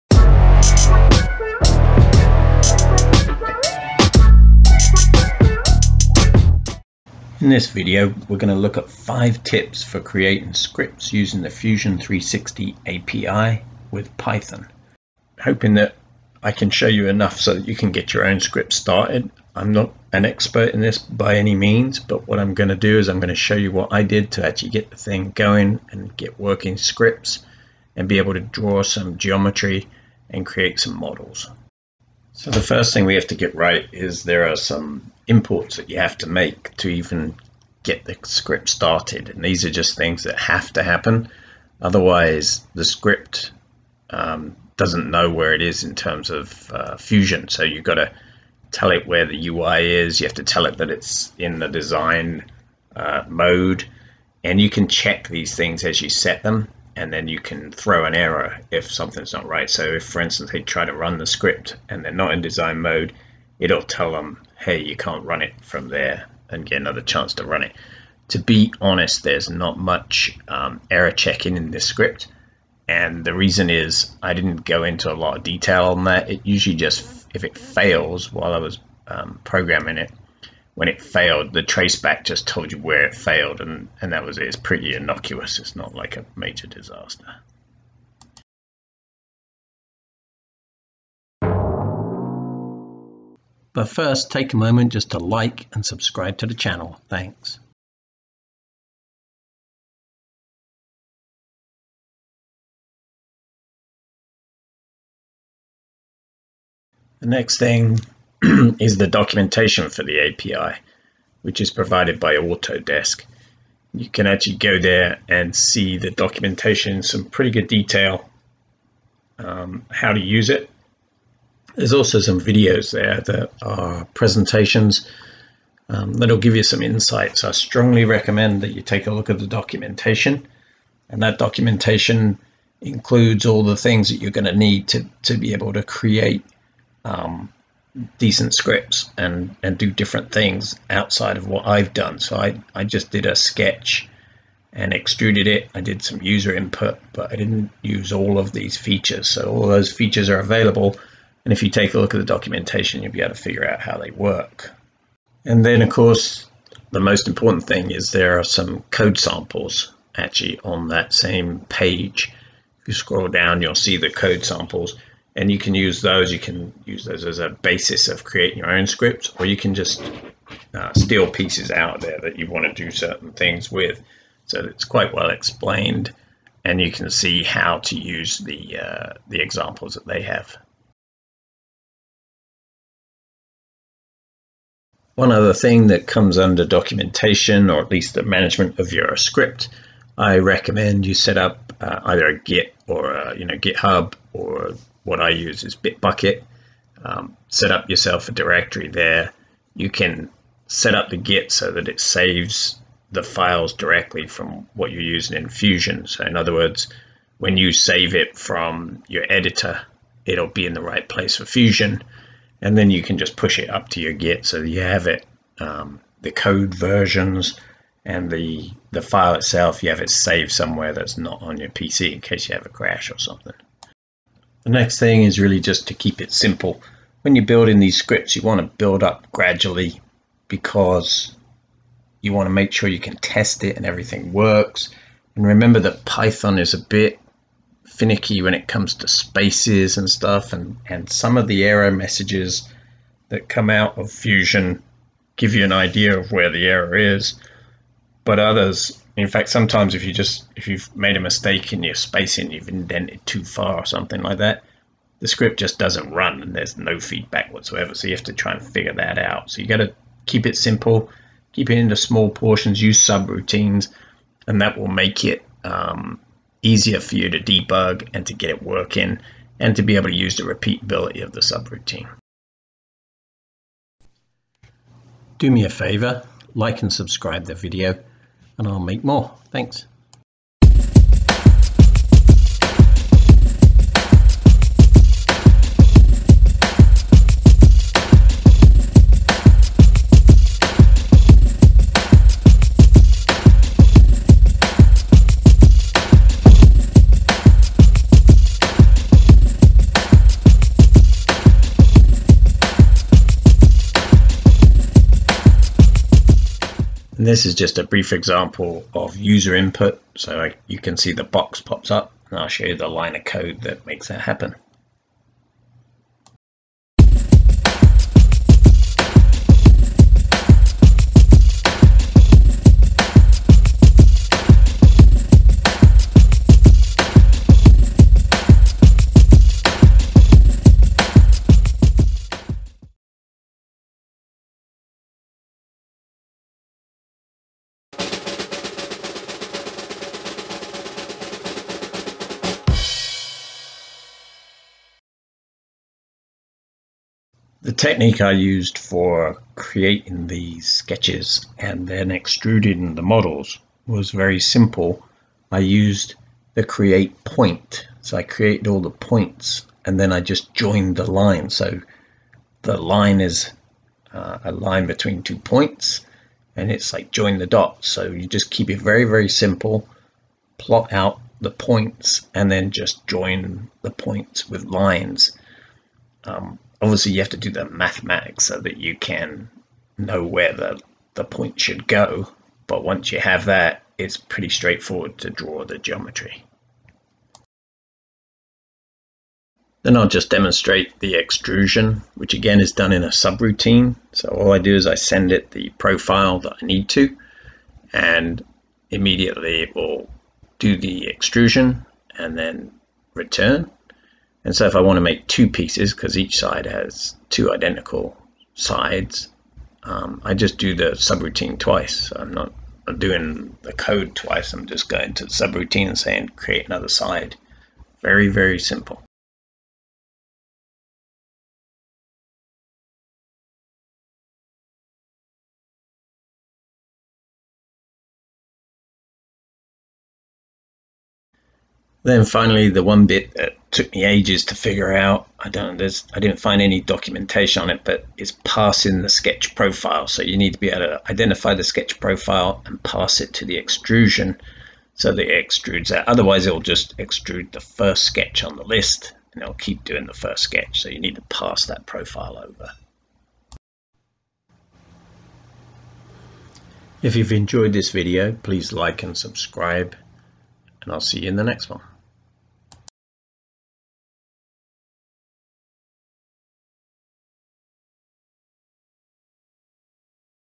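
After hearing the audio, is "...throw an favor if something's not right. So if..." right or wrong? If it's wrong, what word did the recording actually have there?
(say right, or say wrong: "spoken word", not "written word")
wrong: "error", not "favor".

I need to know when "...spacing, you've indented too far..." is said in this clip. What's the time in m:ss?
4:11.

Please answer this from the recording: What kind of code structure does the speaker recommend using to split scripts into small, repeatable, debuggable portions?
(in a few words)
Subroutines.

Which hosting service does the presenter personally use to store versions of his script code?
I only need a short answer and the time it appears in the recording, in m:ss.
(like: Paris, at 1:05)
Bitbucket, at 3:15.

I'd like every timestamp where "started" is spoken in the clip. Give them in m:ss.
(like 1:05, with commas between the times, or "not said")
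0:18, 0:38.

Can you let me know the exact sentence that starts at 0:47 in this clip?
So you've got to tell it where the UI is.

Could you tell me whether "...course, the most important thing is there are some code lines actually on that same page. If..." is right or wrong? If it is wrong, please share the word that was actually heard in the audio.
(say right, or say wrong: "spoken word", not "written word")
wrong: "samples", not "lines".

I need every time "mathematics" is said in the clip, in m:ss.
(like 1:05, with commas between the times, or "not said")
6:17.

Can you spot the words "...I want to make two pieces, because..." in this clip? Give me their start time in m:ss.
6:44.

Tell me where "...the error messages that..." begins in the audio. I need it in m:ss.
4:01.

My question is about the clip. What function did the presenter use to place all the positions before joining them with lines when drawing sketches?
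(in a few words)
Create point.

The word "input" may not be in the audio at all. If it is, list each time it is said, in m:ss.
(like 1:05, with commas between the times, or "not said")
2:26, 5:09.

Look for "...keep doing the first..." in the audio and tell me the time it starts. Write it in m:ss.
7:29.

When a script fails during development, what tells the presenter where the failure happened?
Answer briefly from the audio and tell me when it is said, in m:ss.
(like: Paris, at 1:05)
The traceback, at 1:21.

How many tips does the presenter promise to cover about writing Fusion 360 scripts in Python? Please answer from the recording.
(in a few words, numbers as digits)
5.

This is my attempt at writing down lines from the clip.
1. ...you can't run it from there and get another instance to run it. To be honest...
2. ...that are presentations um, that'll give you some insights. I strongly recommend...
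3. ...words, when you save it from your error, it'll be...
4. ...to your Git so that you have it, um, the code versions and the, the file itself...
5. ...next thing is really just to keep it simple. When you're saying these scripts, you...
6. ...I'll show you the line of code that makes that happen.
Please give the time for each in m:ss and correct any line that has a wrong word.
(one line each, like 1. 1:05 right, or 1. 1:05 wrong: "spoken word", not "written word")
1. 1:04 wrong: "chance", not "instance"
2. 2:03 right
3. 3:26 wrong: "editor", not "error"
4. 3:33 right
5. 3:44 wrong: "building", not "saying"
6. 5:12 right.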